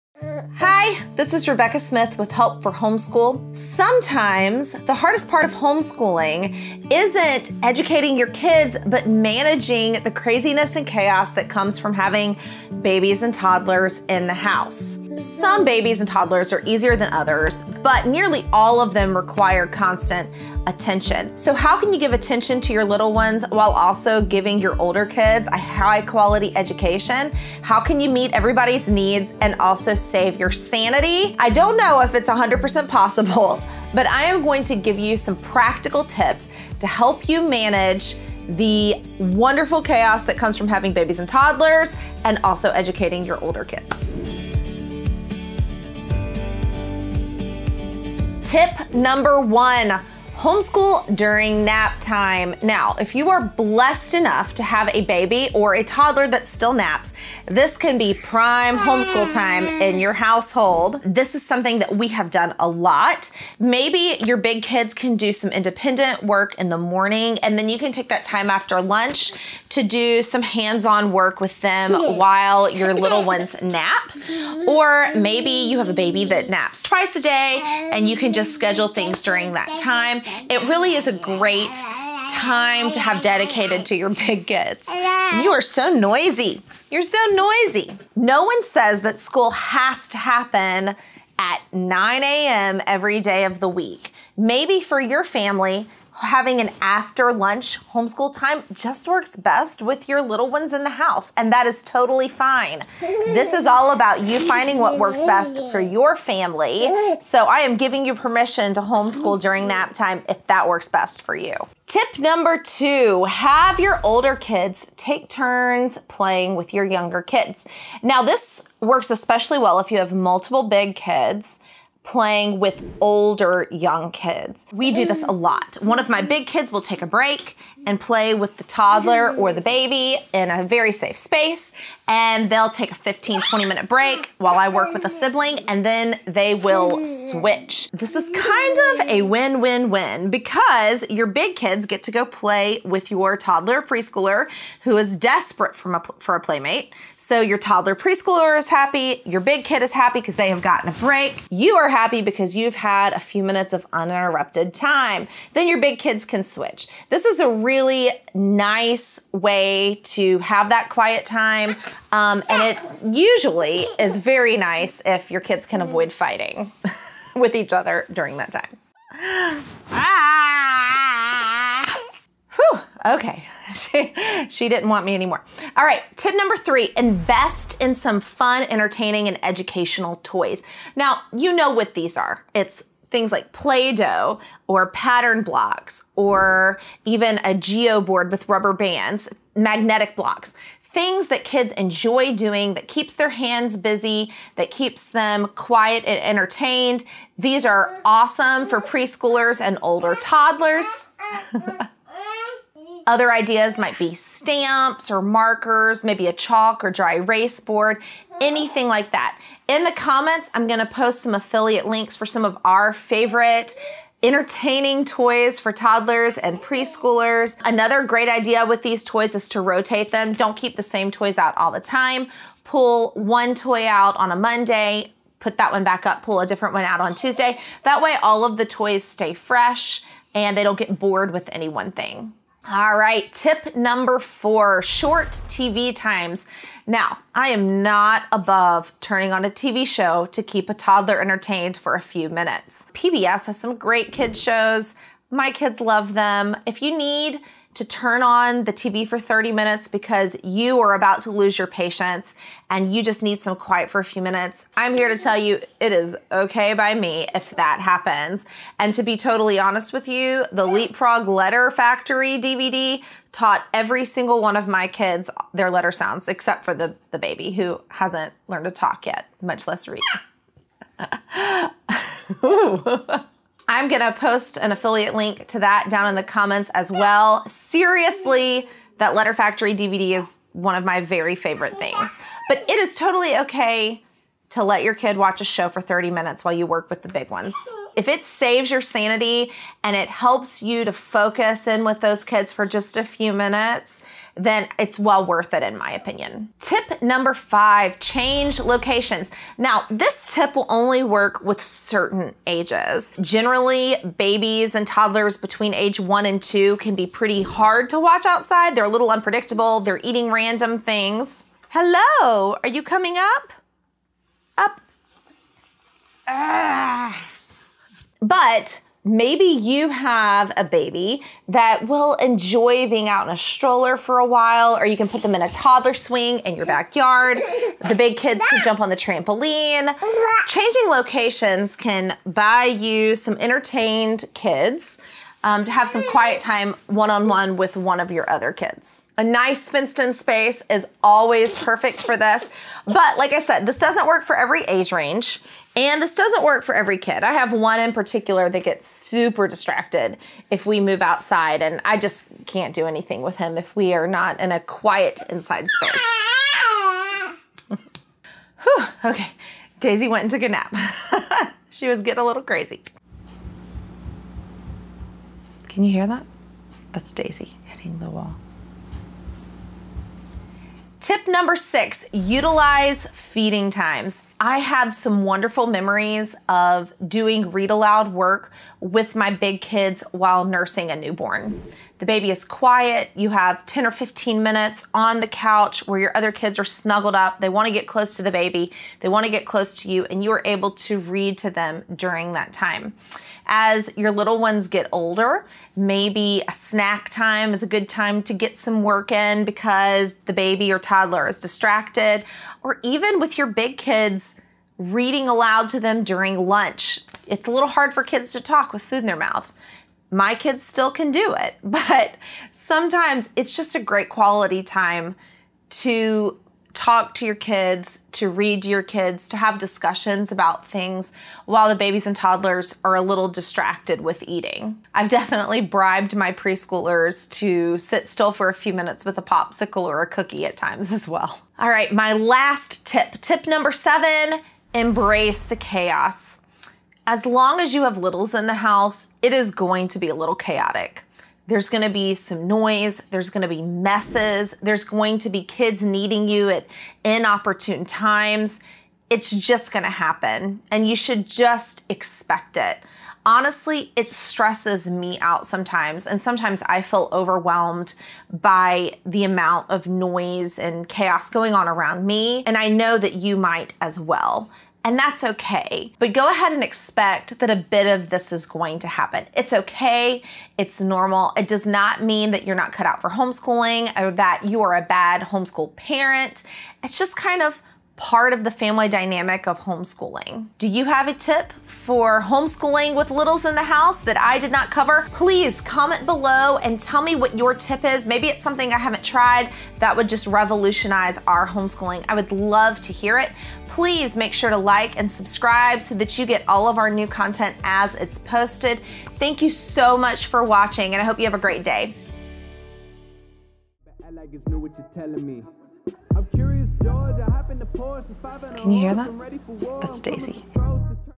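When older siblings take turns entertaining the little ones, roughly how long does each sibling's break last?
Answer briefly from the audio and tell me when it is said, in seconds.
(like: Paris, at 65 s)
15 to 20 minutes, at 132 s.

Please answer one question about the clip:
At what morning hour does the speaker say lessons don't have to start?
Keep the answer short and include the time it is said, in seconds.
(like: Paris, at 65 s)
9 a.m., at 91 s.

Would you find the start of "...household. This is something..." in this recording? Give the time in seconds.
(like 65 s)
60 s.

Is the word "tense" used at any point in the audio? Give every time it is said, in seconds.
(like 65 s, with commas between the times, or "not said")
not said.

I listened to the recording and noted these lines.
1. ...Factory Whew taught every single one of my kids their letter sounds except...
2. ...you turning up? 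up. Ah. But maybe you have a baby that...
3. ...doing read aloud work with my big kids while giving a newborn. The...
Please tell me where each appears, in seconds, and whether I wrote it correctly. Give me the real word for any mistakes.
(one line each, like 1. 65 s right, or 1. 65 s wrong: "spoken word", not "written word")
1. 261 s wrong: "DVD", not "Whew"
2. 312 s wrong: "coming", not "turning"
3. 377 s wrong: "nursing", not "giving".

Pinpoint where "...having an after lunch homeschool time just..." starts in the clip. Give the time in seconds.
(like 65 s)
96 s.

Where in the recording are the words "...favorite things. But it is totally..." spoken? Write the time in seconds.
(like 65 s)
281 s.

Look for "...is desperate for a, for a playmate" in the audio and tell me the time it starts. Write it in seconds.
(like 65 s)
144 s.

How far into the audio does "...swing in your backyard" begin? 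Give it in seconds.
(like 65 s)
325 s.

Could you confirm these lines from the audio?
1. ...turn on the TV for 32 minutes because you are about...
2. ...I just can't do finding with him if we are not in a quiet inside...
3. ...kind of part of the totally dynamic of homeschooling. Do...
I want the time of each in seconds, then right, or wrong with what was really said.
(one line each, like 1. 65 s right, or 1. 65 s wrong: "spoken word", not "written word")
1. 247 s wrong: "30", not "32"
2. 351 s wrong: "anything", not "finding"
3. 477 s wrong: "family", not "totally".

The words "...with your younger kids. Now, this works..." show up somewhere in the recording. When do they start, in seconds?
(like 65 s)
116 s.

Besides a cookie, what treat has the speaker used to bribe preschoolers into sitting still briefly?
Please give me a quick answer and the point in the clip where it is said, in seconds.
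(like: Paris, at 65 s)
Popsicle, at 429 s.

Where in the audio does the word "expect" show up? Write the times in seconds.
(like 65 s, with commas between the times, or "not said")
451 s, 466 s.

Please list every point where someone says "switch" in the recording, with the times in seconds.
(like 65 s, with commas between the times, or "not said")
137 s, 156 s.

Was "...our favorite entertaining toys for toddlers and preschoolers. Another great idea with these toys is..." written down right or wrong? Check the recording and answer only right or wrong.
right.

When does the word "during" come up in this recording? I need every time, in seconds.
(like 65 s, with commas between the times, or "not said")
51 s, 79 s, 109 s, 168 s, 391 s, 406 s.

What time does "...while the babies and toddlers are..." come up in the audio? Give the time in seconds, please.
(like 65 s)
421 s.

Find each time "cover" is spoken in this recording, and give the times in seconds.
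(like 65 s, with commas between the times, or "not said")
484 s.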